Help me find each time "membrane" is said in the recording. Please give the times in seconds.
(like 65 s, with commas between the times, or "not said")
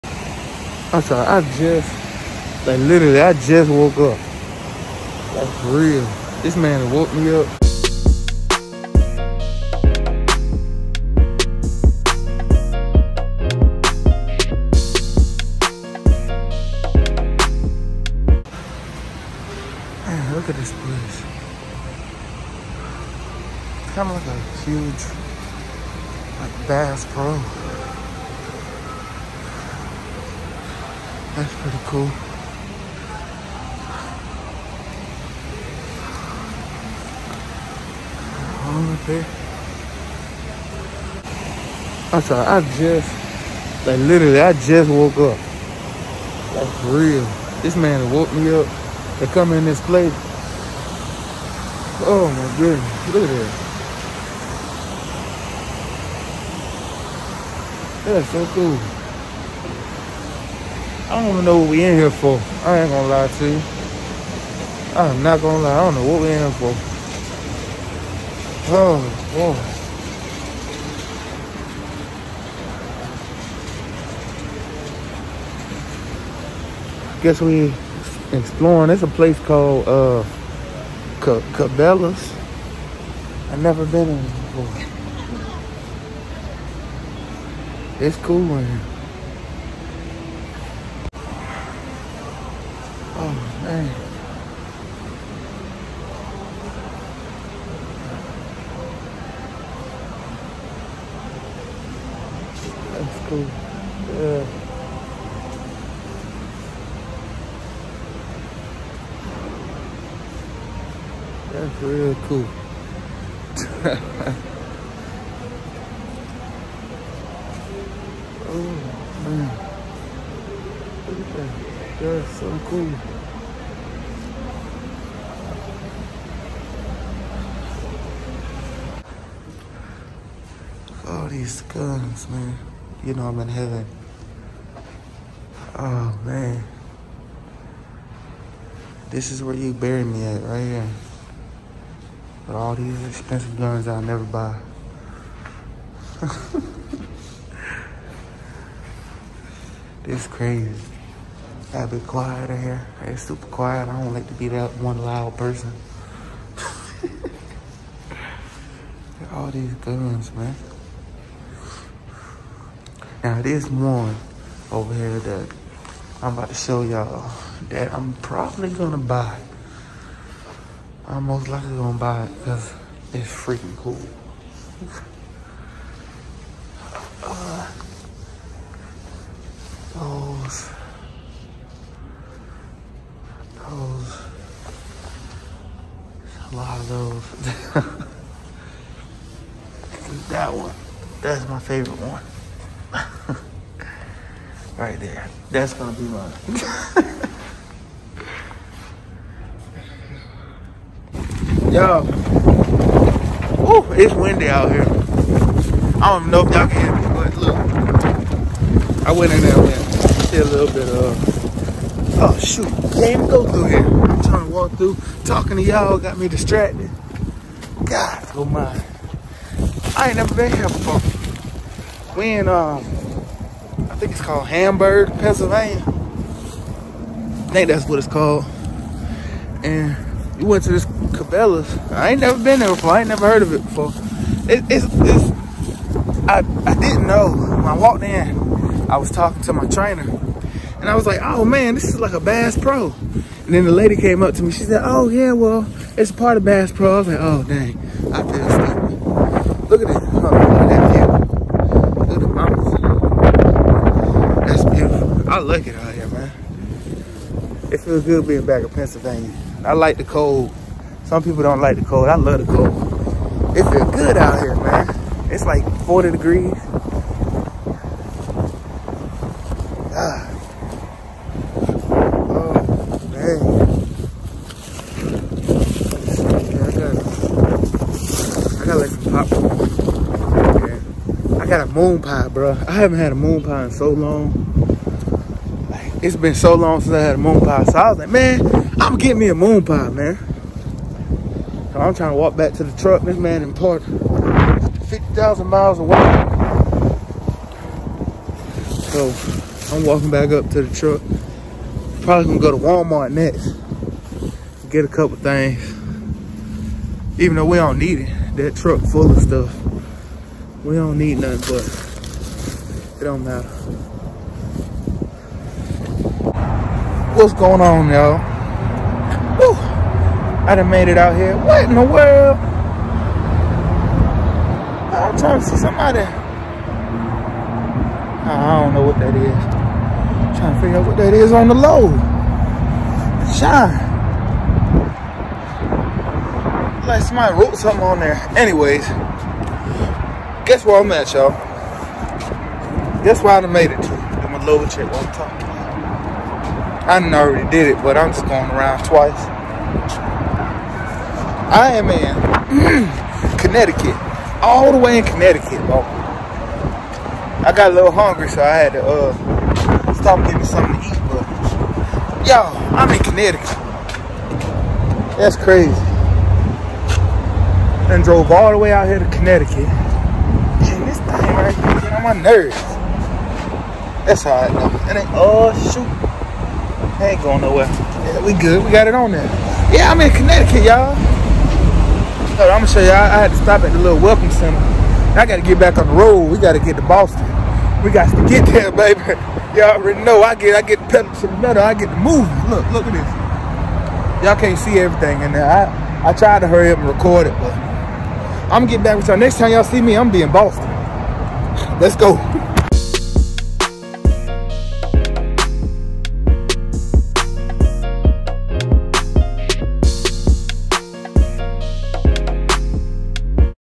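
not said.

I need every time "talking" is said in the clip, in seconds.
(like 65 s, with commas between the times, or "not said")
215 s, 239 s, 345 s.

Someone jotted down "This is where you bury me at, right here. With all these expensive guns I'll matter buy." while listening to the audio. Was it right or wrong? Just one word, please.
wrong.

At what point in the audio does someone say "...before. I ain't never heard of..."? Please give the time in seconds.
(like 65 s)
232 s.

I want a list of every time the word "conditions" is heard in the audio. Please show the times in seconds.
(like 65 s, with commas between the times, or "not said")
not said.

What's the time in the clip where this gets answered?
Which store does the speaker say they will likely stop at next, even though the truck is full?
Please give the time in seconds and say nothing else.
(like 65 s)
302 s.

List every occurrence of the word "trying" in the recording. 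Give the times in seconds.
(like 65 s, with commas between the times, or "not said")
214 s, 291 s, 325 s, 330 s.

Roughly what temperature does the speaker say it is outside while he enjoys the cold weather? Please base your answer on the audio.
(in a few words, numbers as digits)
40 degrees.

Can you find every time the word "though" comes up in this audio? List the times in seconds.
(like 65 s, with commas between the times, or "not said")
307 s, 374 s.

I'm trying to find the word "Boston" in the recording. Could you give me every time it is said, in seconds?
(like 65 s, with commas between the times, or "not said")
386 s, 400 s.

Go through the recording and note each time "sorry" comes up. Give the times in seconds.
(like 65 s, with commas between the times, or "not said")
1 s, 42 s.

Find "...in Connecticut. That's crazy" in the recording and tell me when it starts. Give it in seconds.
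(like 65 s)
362 s.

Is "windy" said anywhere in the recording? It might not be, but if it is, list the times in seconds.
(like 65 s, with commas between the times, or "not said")
204 s.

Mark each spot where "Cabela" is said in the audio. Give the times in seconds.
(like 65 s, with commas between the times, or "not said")
81 s, 230 s.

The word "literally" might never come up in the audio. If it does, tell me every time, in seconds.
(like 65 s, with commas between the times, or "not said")
2 s, 43 s.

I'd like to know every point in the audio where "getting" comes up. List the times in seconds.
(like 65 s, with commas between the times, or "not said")
288 s, 360 s.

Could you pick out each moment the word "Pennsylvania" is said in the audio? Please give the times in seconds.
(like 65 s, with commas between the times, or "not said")
225 s, 258 s.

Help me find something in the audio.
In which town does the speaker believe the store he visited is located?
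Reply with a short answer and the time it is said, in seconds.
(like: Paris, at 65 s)
Hamburg, at 224 s.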